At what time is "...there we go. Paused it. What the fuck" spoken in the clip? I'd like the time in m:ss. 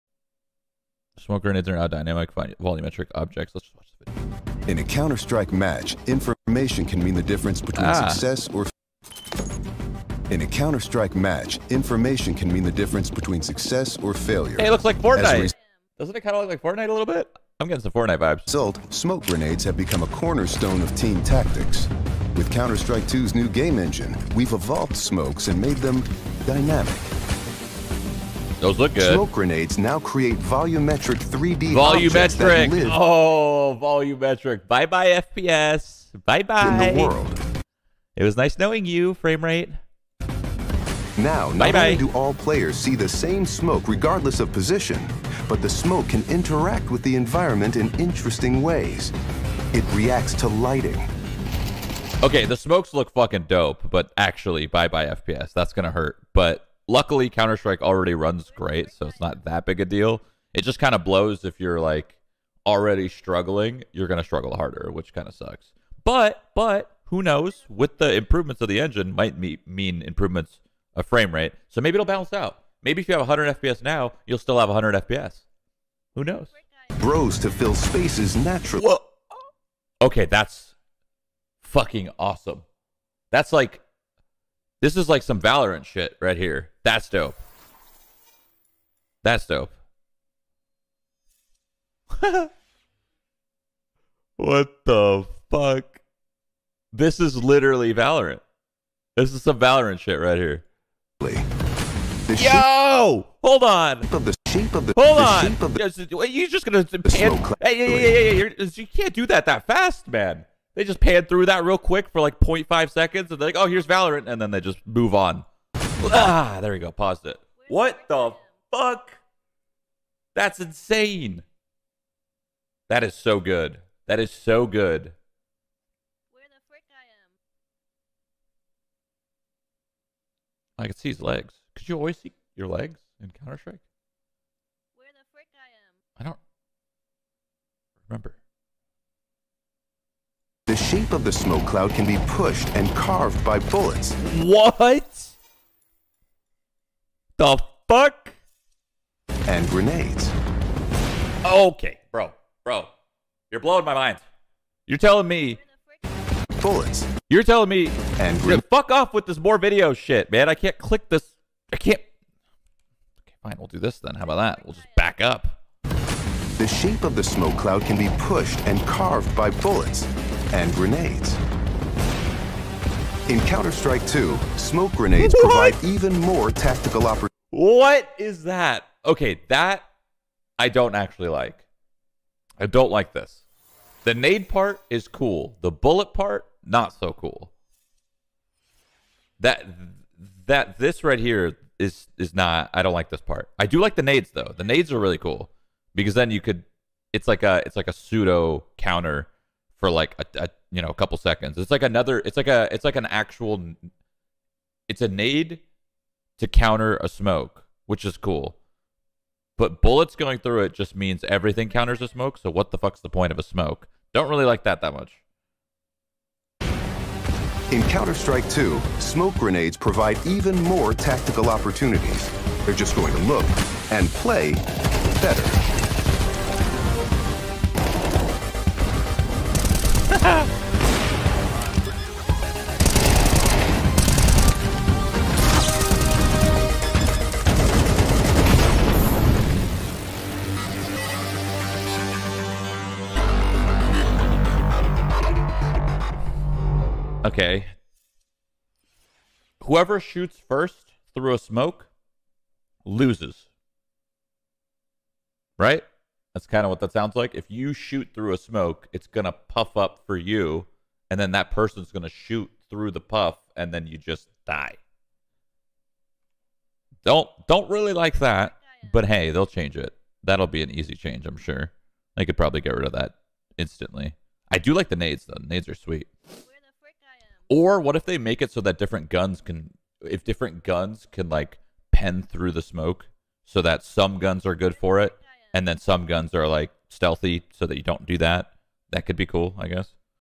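1:56.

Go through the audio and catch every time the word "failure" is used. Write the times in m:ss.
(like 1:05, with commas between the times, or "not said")
0:14.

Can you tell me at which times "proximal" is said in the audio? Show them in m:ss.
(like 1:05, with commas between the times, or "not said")
not said.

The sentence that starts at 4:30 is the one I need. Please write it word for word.
That'll be an easy change, I'm sure.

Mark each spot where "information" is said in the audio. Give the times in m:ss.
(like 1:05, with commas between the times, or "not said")
0:06, 0:11.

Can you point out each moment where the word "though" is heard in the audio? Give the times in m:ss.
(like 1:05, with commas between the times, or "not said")
3:14, 4:35.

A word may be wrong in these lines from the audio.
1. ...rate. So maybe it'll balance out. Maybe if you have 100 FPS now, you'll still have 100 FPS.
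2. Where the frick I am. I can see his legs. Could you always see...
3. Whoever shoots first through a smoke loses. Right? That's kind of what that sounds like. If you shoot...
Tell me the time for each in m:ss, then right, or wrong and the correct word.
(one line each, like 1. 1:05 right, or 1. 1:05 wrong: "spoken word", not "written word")
1. 1:11 right
2. 2:06 right
3. 4:09 right.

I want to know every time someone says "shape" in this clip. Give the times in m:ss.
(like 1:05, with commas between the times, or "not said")
1:44, 2:20, 2:46.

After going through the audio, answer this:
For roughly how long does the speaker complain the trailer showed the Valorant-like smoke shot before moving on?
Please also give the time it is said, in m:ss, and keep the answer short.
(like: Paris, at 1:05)
0.5 seconds, at 1:52.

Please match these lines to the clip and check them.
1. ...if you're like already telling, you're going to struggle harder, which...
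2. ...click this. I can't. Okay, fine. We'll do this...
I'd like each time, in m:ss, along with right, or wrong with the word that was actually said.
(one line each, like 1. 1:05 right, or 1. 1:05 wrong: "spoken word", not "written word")
1. 1:01 wrong: "struggling", not "telling"
2. 2:40 right.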